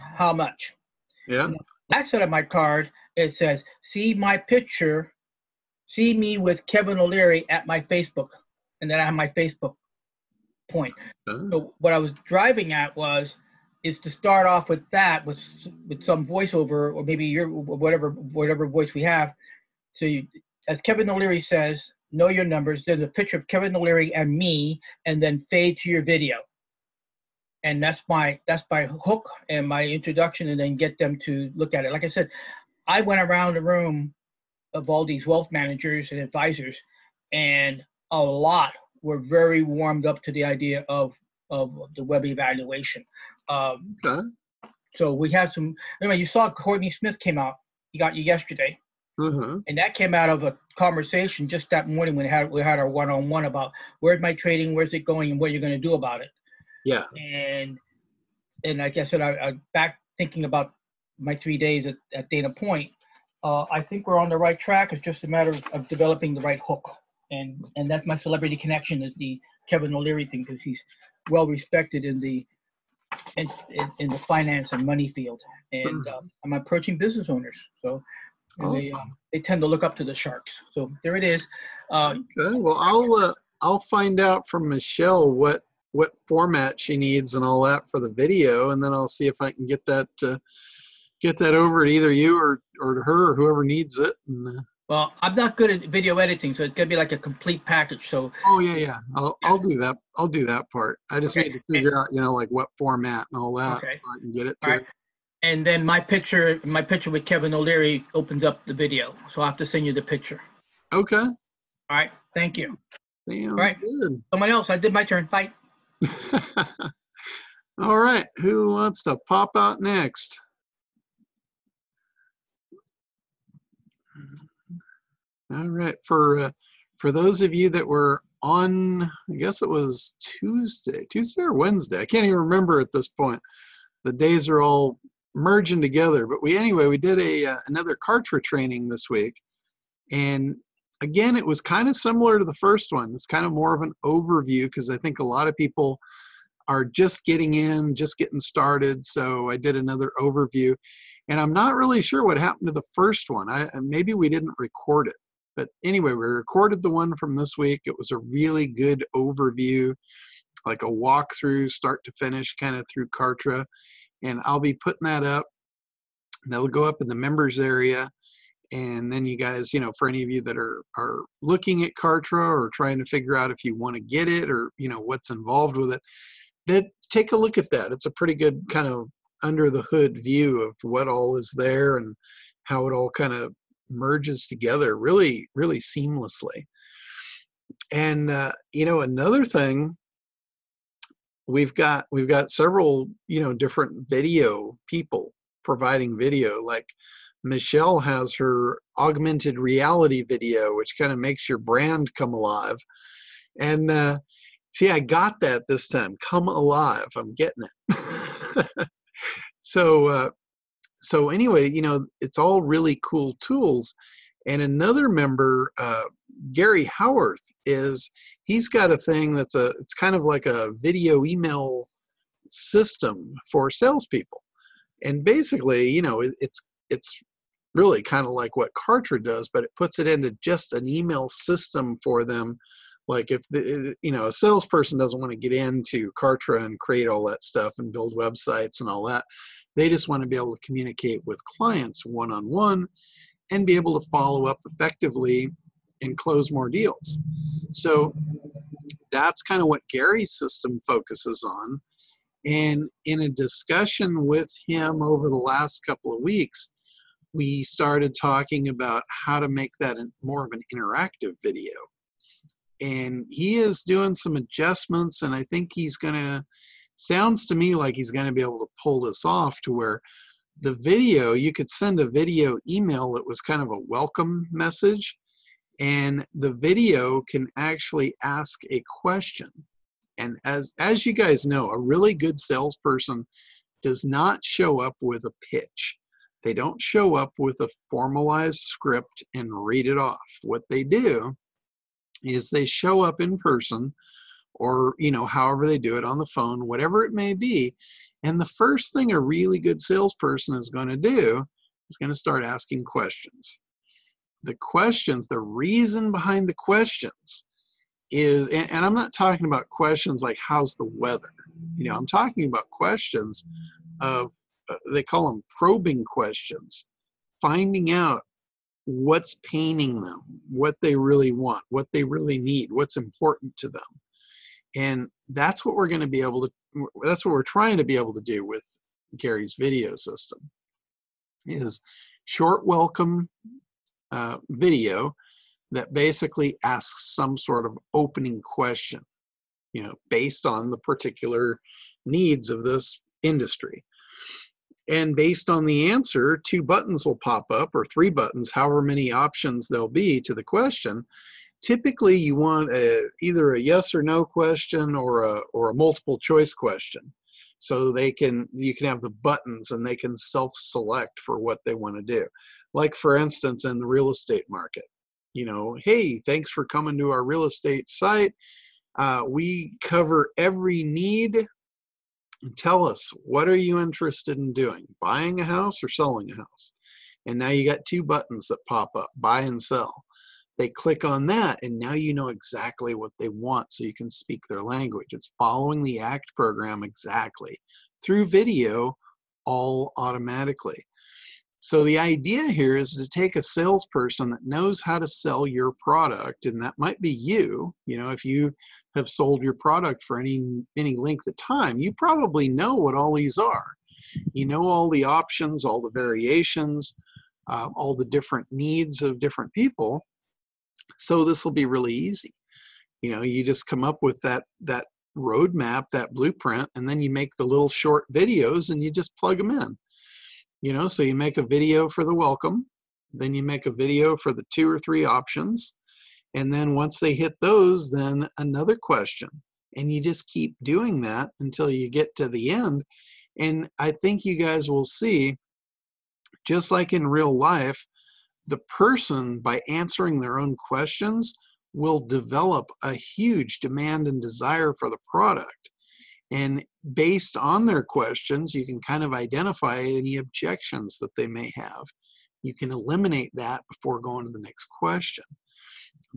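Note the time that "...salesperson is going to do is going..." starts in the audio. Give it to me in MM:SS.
04:59.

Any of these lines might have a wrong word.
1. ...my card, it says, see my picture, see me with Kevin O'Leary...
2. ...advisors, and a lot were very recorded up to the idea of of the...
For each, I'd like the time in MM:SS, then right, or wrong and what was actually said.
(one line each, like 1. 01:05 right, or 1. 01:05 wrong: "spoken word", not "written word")
1. 00:02 right
2. 00:36 wrong: "warmed", not "recorded".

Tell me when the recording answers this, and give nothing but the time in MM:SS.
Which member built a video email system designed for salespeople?
03:36.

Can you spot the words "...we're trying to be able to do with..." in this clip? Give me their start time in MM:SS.
05:27.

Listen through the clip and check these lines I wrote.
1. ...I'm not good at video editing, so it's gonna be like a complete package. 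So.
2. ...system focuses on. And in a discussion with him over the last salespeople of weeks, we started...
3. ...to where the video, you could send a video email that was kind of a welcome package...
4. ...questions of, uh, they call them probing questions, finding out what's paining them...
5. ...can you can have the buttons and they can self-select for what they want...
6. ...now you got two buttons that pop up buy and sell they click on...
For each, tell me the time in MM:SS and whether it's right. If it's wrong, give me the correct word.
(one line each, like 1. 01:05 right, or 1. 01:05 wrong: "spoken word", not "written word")
1. 01:35 right
2. 04:10 wrong: "couple", not "salespeople"
3. 04:29 wrong: "message", not "package"
4. 05:12 right
5. 05:58 right
6. 06:17 right.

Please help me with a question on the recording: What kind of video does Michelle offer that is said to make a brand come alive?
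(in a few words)
augmented reality video.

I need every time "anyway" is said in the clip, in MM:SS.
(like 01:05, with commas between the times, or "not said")
00:46, 02:16, 02:35, 03:31.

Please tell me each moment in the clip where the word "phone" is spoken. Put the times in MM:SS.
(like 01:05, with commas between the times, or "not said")
04:56.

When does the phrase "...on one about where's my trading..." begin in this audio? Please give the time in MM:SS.
00:53.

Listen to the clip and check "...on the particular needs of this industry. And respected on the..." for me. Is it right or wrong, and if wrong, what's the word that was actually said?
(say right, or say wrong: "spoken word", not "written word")
wrong: "based", not "respected".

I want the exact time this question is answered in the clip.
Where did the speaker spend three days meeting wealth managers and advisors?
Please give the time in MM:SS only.
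01:02.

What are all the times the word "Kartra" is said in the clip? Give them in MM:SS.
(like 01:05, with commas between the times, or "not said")
02:17, 02:43, 02:51, 03:48, 03:56.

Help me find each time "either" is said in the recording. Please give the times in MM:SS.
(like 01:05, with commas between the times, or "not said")
01:31, 05:53.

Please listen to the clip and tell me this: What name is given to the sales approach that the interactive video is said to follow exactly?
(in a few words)
ACT program.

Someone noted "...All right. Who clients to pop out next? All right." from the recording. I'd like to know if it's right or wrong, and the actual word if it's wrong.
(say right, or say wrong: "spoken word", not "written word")
wrong: "wants", not "clients".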